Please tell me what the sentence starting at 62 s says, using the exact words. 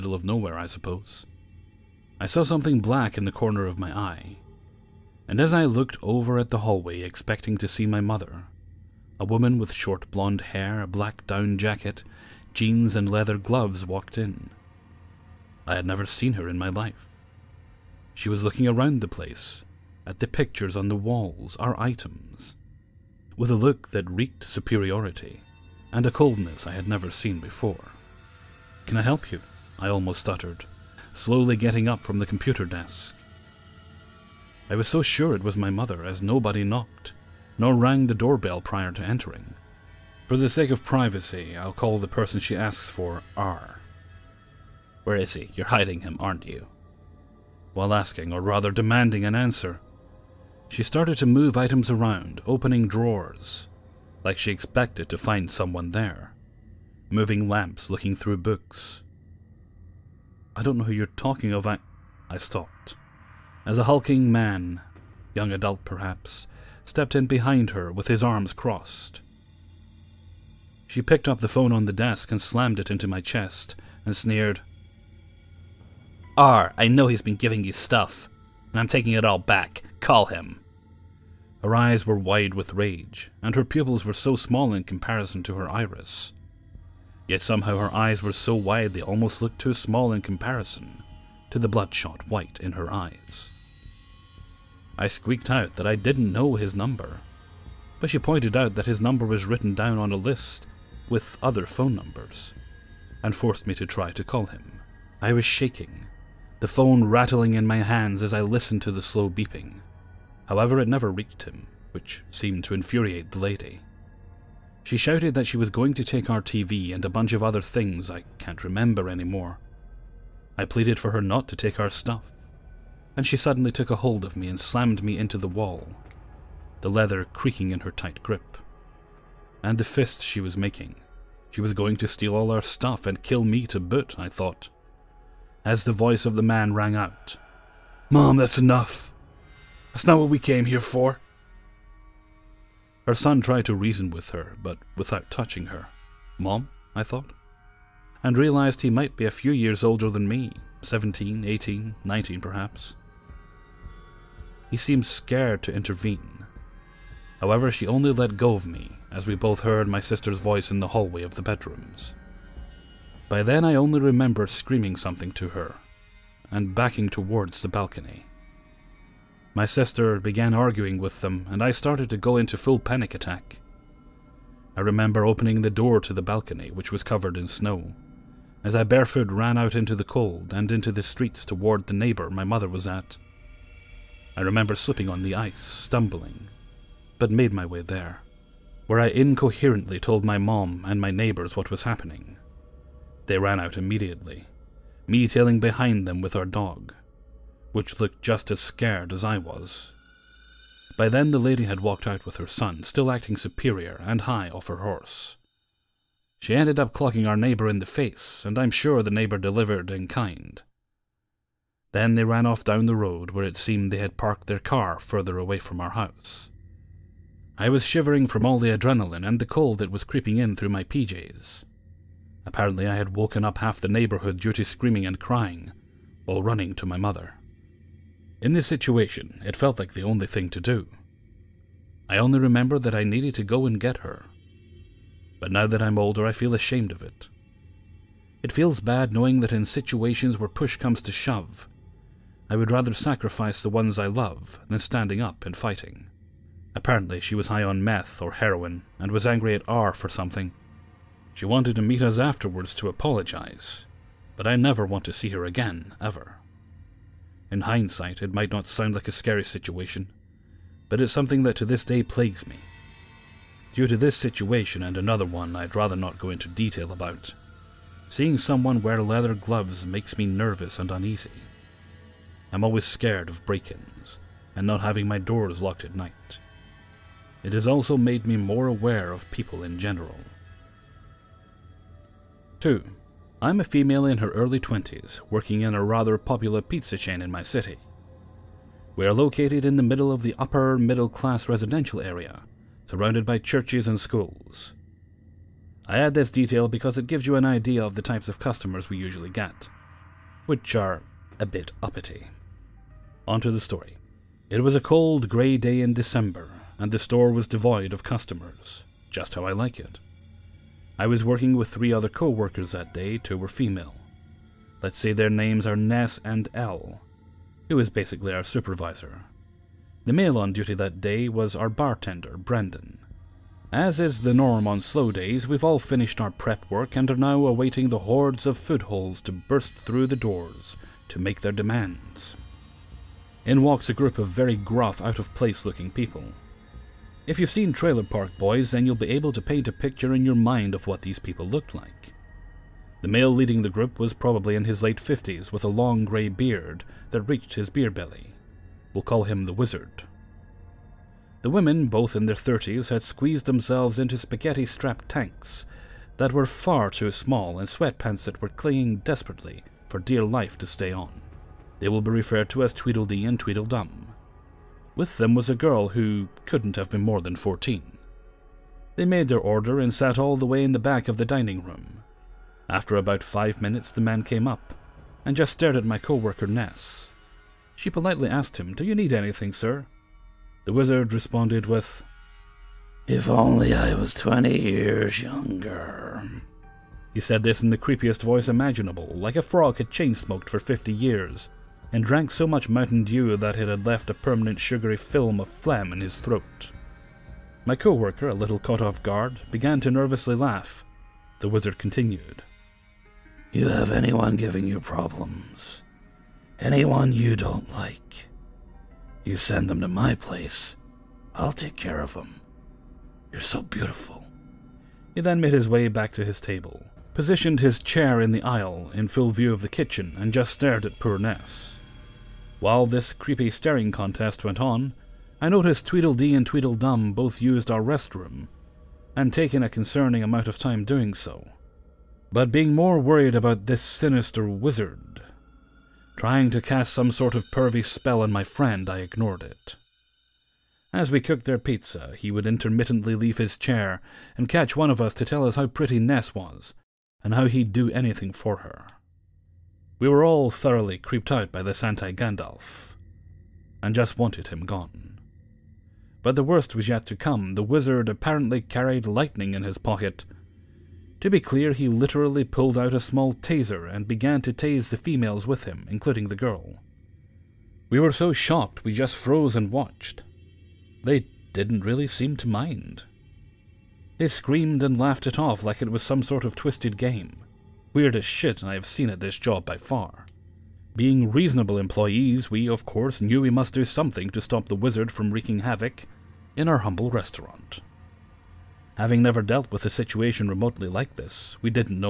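I stopped as a hulking man, young adult perhaps, stepped in behind her with his arms crossed.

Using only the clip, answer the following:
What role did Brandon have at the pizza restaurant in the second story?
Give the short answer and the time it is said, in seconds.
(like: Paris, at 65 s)
bartender, at 321 s.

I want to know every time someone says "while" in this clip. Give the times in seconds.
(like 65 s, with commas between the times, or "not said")
47 s, 226 s, 422 s.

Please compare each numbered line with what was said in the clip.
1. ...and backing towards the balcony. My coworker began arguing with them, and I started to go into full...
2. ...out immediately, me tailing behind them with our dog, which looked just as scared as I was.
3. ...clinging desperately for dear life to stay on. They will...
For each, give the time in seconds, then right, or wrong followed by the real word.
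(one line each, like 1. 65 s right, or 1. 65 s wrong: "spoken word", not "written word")
1. 166 s wrong: "sister", not "coworker"
2. 193 s right
3. 358 s right.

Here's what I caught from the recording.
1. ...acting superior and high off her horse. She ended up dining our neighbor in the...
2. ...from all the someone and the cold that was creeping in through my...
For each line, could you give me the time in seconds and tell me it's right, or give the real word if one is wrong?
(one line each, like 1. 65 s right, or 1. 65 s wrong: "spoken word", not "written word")
1. 203 s wrong: "clocking", not "dining"
2. 218 s wrong: "adrenaline", not "someone".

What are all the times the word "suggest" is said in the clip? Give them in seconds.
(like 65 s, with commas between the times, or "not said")
not said.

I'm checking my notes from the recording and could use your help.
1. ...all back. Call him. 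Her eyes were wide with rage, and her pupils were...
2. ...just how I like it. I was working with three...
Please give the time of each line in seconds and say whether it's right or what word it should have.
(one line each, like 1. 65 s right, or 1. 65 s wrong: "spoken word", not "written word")
1. 79 s right
2. 309 s right.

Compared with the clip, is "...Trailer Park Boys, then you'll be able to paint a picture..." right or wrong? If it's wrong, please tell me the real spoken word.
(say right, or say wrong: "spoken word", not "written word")
right.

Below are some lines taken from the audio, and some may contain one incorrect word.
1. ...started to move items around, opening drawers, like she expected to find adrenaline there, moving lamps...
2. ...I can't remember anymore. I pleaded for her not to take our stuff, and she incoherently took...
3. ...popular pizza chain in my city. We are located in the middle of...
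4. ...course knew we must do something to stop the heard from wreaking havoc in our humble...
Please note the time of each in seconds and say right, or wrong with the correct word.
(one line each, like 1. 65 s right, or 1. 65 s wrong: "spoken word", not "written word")
1. 50 s wrong: "someone", not "adrenaline"
2. 118 s wrong: "suddenly", not "incoherently"
3. 286 s right
4. 482 s wrong: "wizard", not "heard".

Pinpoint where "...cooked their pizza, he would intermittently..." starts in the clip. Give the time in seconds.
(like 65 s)
441 s.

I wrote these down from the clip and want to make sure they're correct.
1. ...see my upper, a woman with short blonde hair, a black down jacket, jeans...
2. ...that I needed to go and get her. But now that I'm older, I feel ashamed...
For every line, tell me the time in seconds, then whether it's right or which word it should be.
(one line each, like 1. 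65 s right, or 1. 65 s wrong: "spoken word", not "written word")
1. 7 s wrong: "mother", not "upper"
2. 232 s right.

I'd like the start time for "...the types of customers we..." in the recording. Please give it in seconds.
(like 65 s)
297 s.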